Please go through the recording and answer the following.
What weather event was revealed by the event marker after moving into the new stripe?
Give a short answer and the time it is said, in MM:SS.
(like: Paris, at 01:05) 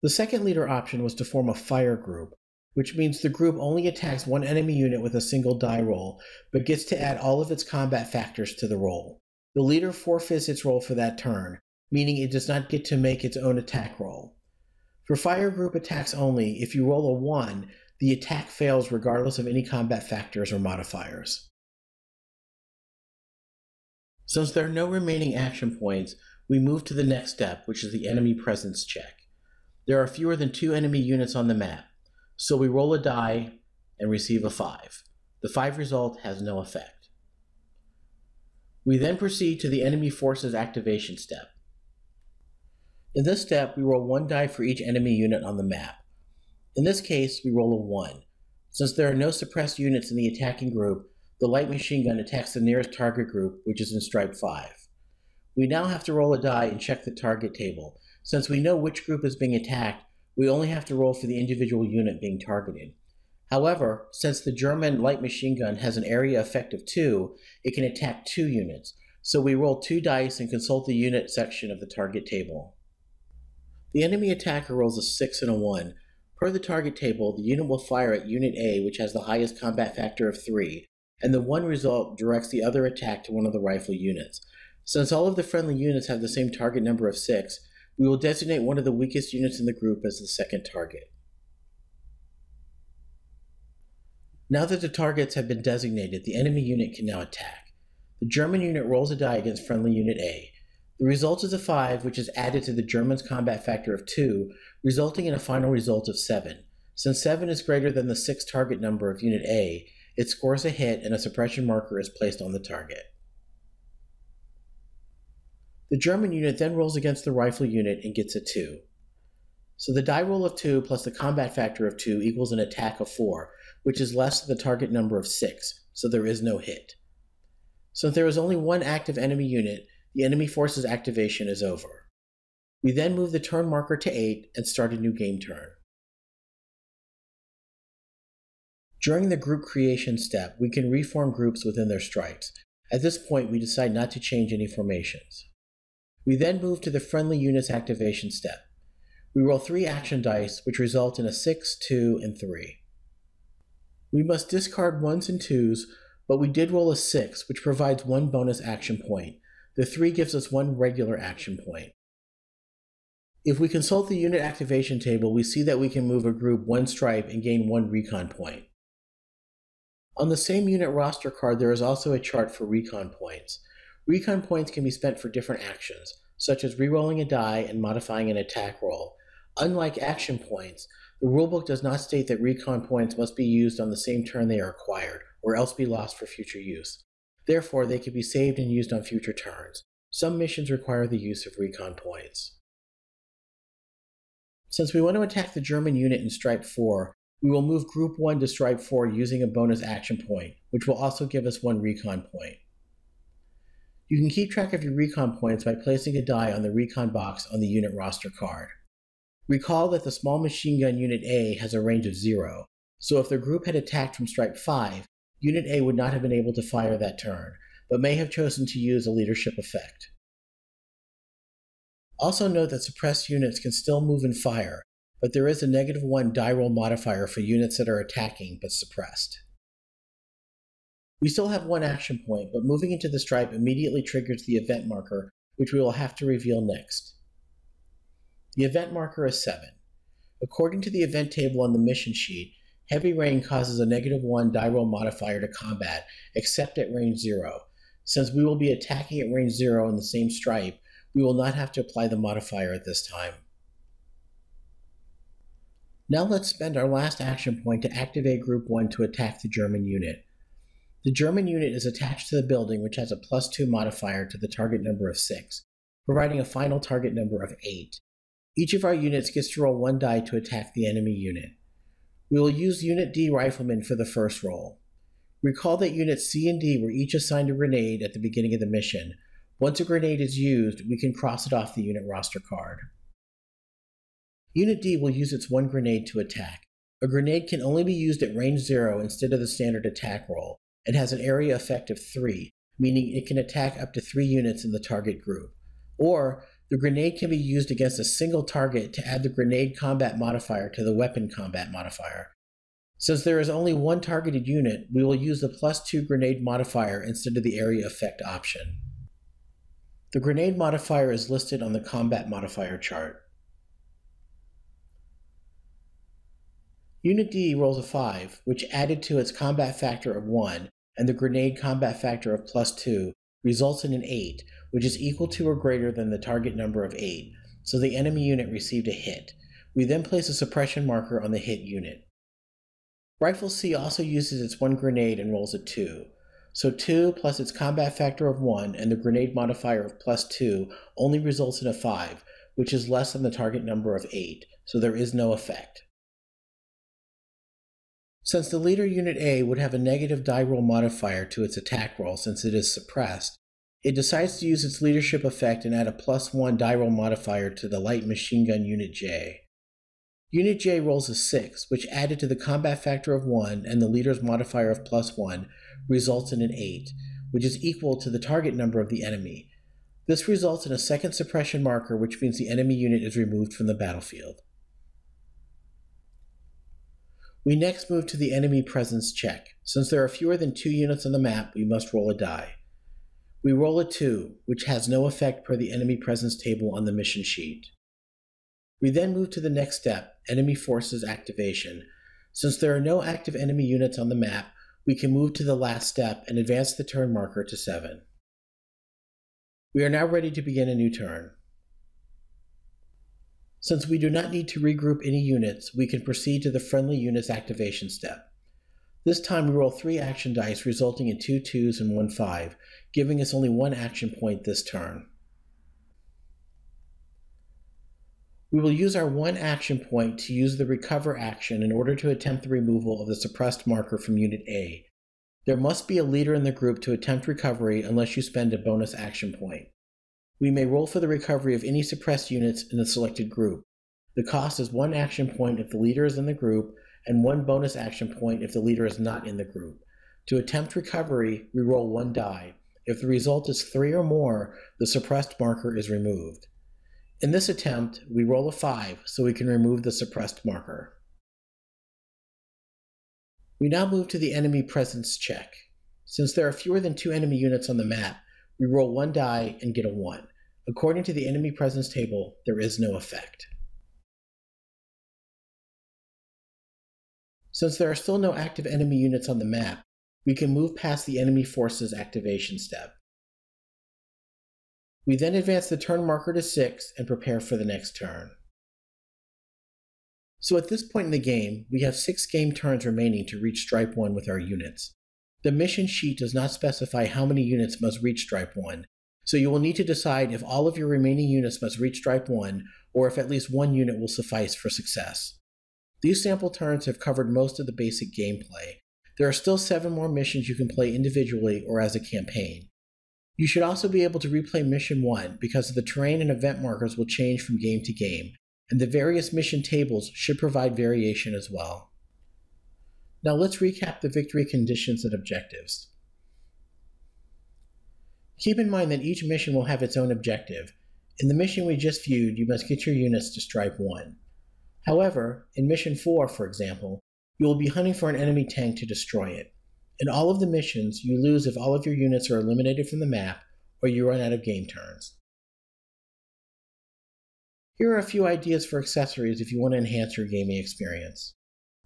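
heavy rain, at 04:02.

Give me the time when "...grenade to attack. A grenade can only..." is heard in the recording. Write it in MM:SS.
04:45.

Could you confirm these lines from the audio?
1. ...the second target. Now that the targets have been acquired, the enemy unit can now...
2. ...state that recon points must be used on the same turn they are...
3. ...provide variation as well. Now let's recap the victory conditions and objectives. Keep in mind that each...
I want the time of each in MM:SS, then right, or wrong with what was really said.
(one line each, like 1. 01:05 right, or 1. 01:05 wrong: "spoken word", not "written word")
1. 01:30 wrong: "designated", not "acquired"
2. 03:02 right
3. 08:30 right.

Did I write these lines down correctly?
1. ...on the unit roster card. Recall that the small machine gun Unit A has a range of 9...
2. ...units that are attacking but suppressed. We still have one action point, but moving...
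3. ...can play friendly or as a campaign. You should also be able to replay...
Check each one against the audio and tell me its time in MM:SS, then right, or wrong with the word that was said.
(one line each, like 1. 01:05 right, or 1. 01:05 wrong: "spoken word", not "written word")
1. 03:27 wrong: "0", not "9"
2. 03:47 right
3. 08:20 wrong: "individually", not "friendly".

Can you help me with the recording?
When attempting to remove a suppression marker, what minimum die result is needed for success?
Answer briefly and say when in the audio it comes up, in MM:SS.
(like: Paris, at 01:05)
3, at 07:23.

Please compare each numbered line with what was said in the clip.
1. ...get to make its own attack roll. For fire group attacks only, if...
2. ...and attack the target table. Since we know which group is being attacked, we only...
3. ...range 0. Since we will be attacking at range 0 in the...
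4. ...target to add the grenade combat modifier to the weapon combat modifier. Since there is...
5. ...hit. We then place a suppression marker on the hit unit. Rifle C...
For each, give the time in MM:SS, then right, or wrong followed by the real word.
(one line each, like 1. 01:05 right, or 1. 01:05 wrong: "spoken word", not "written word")
1. 00:12 right
2. 00:56 wrong: "check", not "attack"
3. 04:06 right
4. 04:58 right
5. 05:28 right.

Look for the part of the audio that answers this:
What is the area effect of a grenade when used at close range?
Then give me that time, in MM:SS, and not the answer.
04:51.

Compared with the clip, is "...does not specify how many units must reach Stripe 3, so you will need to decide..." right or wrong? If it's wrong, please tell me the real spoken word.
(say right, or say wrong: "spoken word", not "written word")
wrong: "1", not "3".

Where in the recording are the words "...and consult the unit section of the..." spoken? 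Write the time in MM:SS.
01:10.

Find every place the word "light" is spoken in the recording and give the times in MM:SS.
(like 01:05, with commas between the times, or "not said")
00:51, 01:05, 05:57.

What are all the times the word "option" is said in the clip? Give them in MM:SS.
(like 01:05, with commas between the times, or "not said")
00:00, 05:08.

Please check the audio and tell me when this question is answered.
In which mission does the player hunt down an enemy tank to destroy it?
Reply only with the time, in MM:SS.
08:45.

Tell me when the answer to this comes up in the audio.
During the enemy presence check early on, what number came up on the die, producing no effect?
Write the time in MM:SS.
00:34.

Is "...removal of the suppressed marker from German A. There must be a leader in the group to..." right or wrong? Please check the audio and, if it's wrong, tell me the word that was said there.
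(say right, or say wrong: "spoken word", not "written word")
wrong: "Unit", not "German".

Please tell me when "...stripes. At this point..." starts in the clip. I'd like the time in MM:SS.
02:21.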